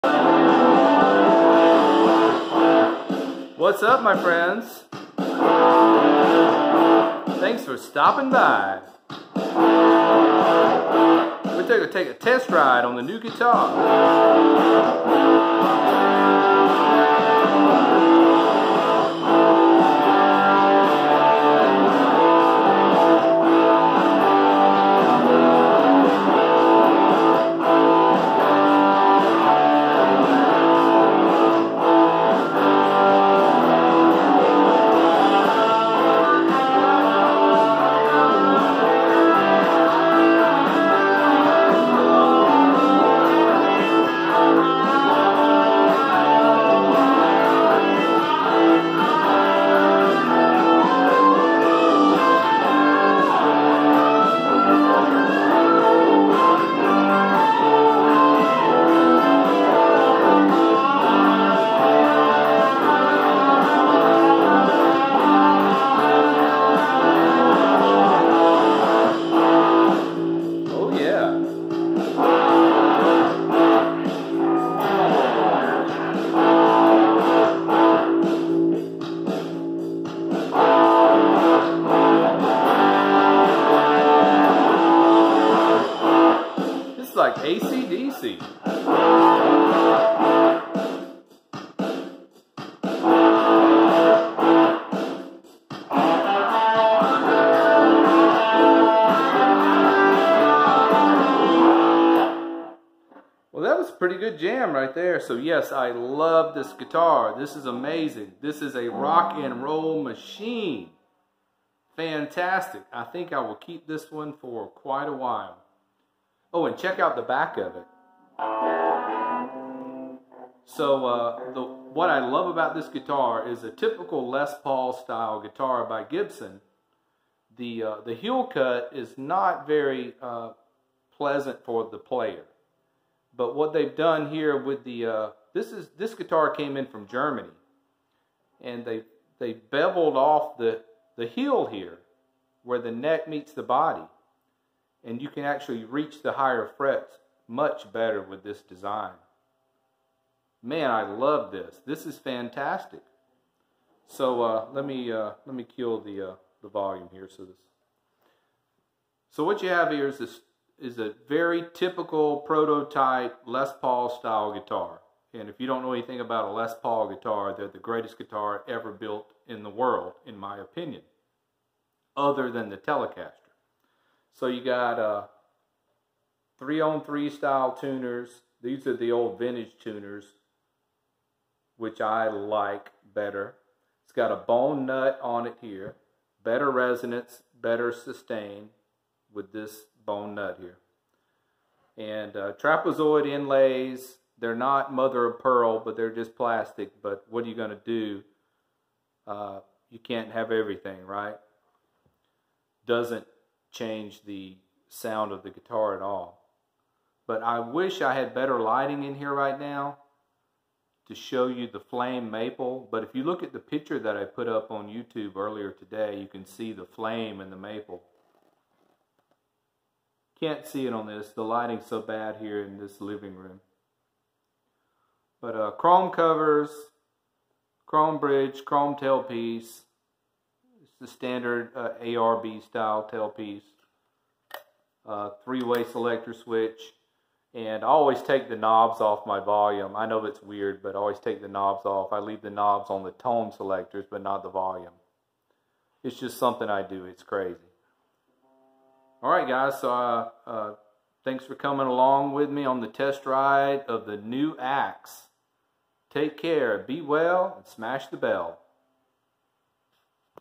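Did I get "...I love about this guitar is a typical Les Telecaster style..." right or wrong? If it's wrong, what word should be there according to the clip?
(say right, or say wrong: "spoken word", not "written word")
wrong: "Paul", not "Telecaster".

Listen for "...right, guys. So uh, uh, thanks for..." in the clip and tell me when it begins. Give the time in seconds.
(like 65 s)
249 s.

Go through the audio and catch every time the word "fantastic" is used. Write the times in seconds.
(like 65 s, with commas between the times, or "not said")
111 s, 152 s.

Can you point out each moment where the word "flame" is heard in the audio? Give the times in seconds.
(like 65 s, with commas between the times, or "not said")
211 s, 216 s.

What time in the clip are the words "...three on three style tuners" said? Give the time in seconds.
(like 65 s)
176 s.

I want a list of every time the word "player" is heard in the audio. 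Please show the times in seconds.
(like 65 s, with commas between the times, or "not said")
131 s.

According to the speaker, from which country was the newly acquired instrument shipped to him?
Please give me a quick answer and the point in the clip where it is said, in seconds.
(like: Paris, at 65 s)
Germany, at 137 s.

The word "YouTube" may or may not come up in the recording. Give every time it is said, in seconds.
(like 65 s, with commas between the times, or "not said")
214 s.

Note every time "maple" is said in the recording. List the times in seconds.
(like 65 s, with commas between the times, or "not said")
212 s, 217 s.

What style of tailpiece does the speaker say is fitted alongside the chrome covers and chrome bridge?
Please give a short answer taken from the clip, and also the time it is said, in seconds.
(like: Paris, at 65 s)
ARB style, at 232 s.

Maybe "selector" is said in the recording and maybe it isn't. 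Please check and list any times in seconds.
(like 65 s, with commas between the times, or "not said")
235 s, 243 s.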